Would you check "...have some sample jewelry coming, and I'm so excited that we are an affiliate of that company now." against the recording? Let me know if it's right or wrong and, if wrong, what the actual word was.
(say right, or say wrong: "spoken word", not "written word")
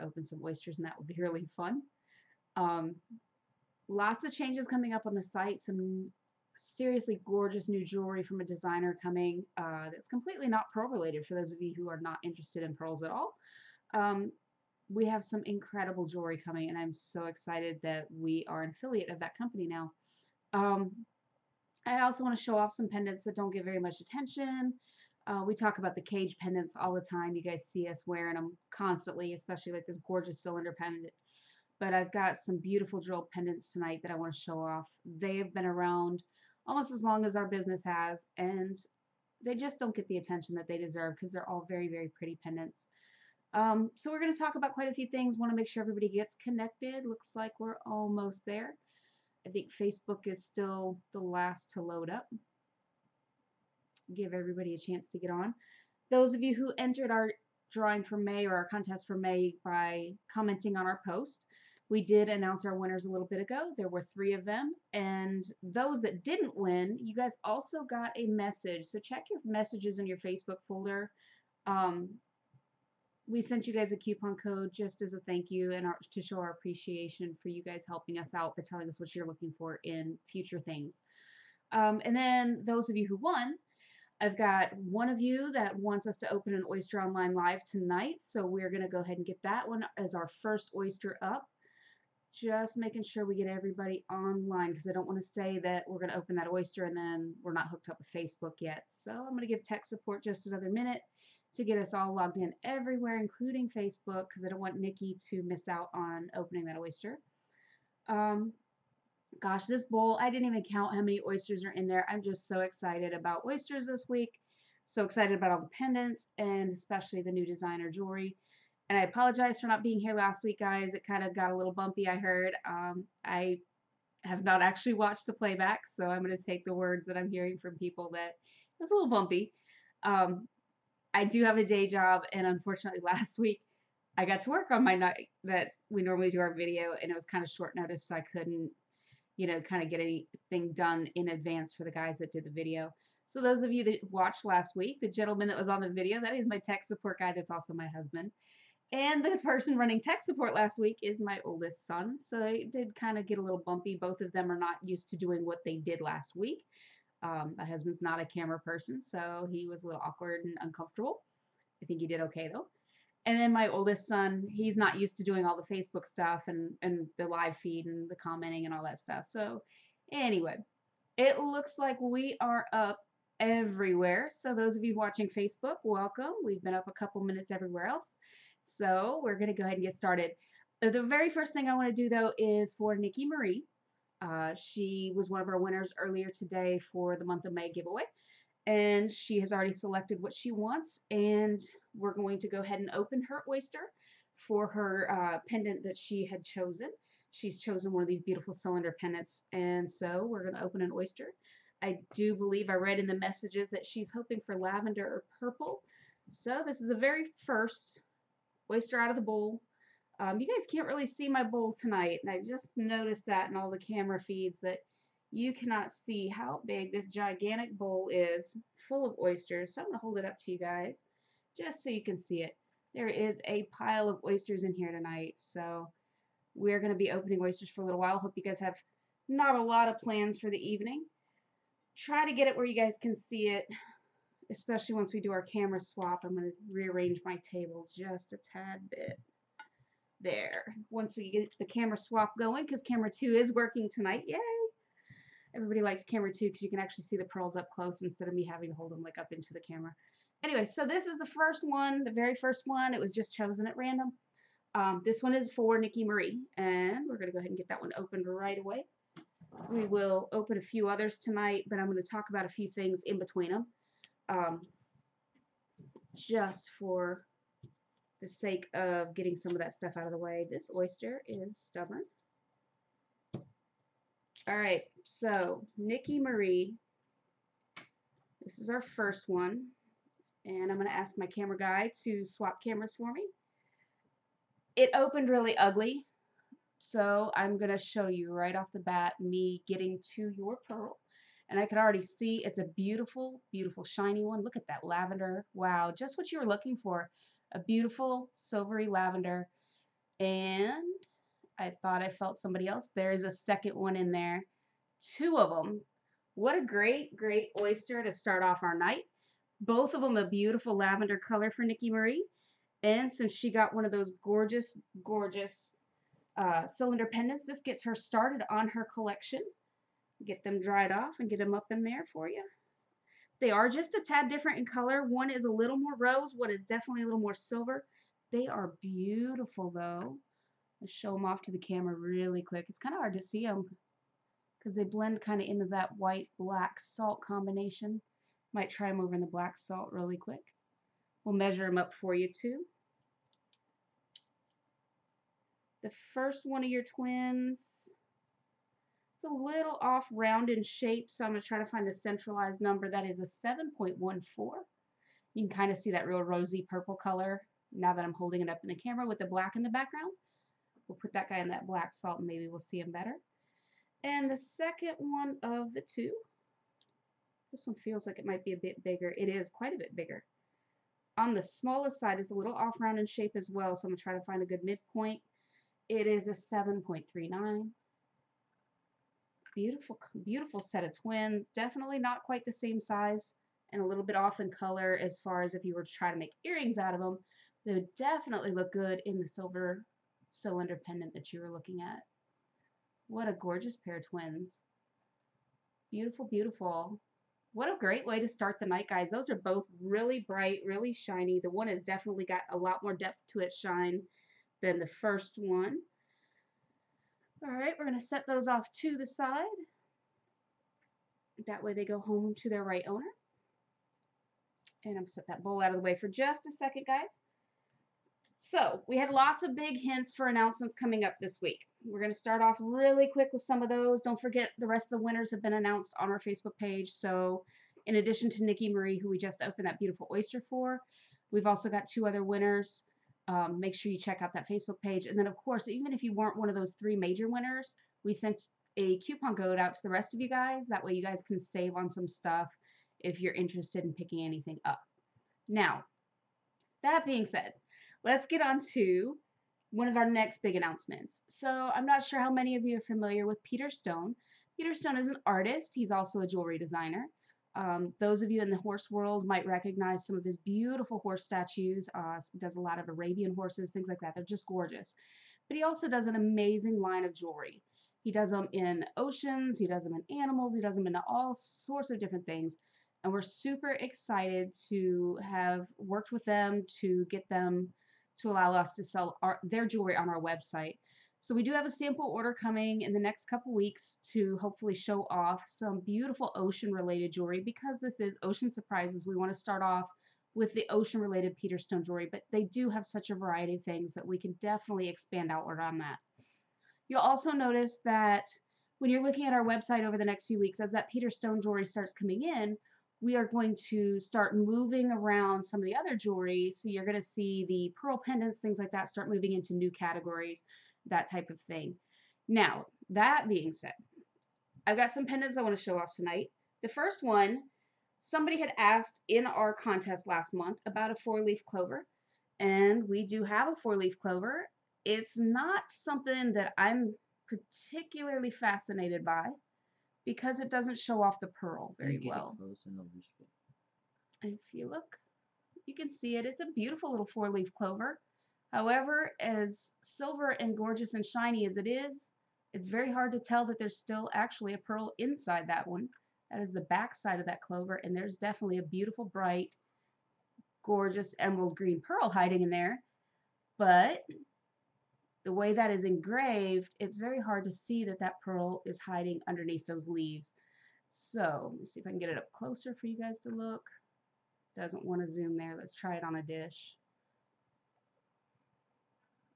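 wrong: "incredible", not "sample".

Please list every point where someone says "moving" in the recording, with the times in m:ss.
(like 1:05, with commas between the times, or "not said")
8:24, 8:29.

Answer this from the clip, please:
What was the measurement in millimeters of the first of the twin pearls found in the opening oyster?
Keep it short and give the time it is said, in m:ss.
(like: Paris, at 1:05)
7.14, at 5:53.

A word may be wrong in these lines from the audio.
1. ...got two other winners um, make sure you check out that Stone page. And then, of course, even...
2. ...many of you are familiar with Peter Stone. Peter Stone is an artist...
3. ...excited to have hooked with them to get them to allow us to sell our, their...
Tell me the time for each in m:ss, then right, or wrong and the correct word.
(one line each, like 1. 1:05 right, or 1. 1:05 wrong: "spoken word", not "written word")
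1. 7:11 wrong: "Facebook", not "Stone"
2. 7:32 right
3. 7:53 wrong: "worked", not "hooked".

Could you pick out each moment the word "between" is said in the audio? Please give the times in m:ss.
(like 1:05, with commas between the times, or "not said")
4:23.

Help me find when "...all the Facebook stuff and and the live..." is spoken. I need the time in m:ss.
2:45.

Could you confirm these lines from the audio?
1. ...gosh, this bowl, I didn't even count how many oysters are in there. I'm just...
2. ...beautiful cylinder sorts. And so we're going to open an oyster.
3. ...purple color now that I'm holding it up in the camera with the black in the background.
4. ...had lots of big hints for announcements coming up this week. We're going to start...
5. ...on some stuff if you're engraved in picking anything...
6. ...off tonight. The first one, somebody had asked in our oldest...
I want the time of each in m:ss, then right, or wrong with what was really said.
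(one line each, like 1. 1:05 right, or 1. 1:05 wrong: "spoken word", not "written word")
1. 1:49 right
2. 3:18 wrong: "pendants", not "sorts"
3. 5:56 right
4. 6:58 right
5. 7:21 wrong: "interested", not "engraved"
6. 8:35 wrong: "contest", not "oldest".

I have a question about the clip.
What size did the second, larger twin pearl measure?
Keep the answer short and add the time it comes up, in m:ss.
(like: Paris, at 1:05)
7.39, at 6:16.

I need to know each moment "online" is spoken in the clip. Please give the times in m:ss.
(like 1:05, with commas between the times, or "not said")
1:27, 1:34.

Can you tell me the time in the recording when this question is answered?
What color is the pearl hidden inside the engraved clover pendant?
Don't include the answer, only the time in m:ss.
9:11.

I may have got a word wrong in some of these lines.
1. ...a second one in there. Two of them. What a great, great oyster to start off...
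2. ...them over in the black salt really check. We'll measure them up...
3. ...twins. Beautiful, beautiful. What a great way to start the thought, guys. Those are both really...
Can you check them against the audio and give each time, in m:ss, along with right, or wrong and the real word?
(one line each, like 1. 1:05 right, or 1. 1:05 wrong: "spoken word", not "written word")
1. 5:03 right
2. 5:38 wrong: "quick", not "check"
3. 6:34 wrong: "night", not "thought".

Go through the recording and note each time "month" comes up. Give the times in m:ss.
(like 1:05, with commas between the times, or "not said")
3:07, 8:40.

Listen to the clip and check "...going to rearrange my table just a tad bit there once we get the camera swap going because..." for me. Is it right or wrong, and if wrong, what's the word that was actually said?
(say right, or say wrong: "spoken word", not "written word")
right.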